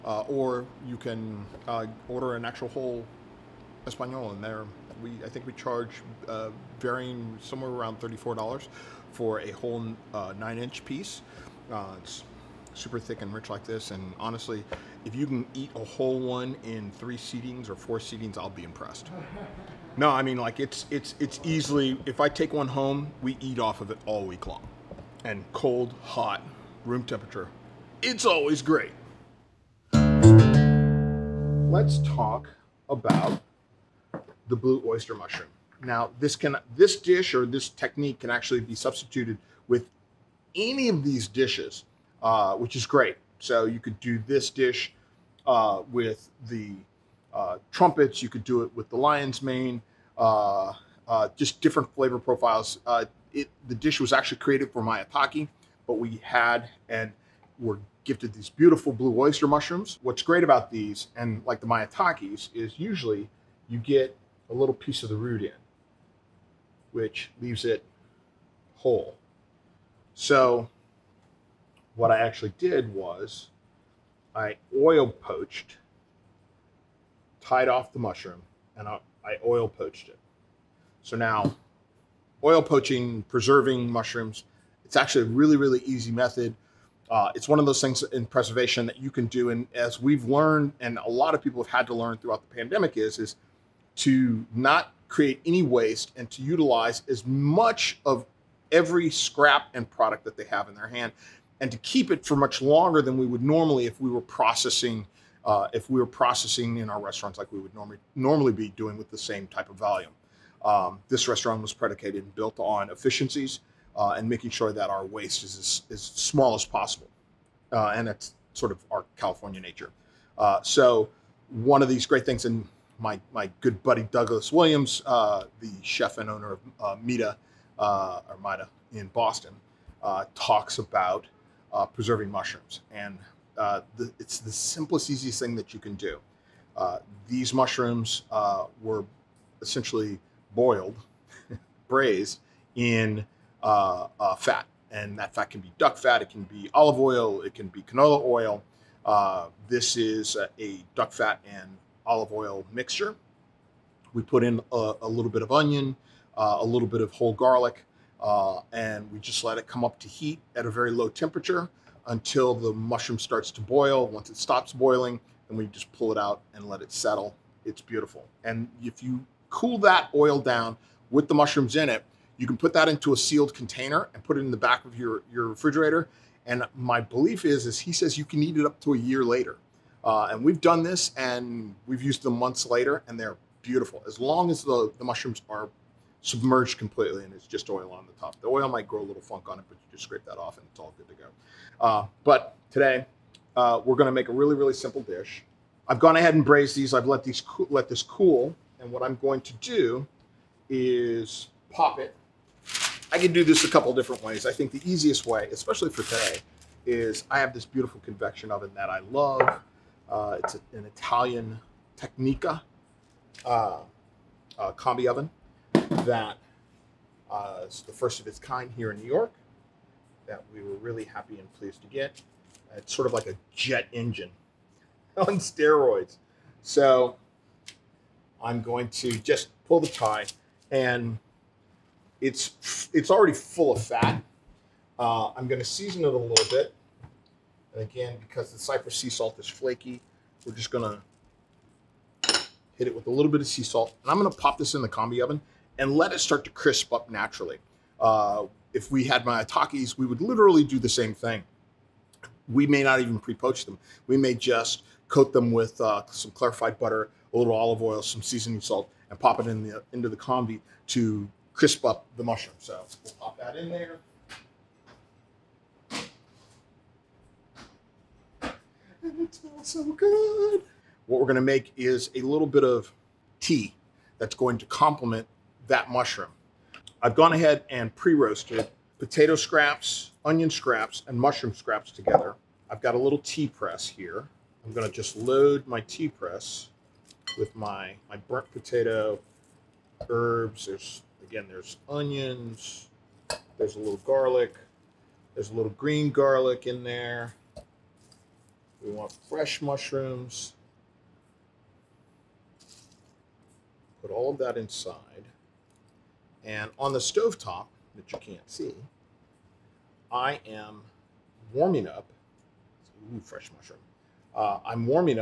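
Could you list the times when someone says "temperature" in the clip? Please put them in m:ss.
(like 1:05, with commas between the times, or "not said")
0:27, 2:41.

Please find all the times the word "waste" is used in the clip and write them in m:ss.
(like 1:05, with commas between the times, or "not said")
1:35, 1:55.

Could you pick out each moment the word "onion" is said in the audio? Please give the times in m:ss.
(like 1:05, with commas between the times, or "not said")
2:35, 4:40, 4:51.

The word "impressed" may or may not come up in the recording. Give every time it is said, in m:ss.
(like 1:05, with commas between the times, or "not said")
0:18.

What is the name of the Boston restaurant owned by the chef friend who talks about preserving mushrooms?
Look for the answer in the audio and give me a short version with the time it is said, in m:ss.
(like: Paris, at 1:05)
Mida, at 2:08.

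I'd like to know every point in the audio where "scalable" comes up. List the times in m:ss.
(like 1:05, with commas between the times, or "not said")
not said.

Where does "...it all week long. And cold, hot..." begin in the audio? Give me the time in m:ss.
0:23.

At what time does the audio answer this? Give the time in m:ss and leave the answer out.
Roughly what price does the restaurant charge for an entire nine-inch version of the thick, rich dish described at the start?
0:07.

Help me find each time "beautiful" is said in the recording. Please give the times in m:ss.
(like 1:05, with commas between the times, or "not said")
0:58, 2:47, 3:03, 3:27.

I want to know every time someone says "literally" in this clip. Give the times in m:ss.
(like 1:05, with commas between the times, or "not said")
4:10.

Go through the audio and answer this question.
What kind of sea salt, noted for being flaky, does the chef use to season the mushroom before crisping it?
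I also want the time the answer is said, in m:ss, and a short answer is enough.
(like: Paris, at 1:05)
Cyprus sea salt, at 3:58.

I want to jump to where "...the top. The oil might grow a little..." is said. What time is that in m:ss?
3:08.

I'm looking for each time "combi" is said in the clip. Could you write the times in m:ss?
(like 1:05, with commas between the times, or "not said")
3:34, 4:04, 4:20.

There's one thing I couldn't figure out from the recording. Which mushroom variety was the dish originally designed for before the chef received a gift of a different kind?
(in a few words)
maitake.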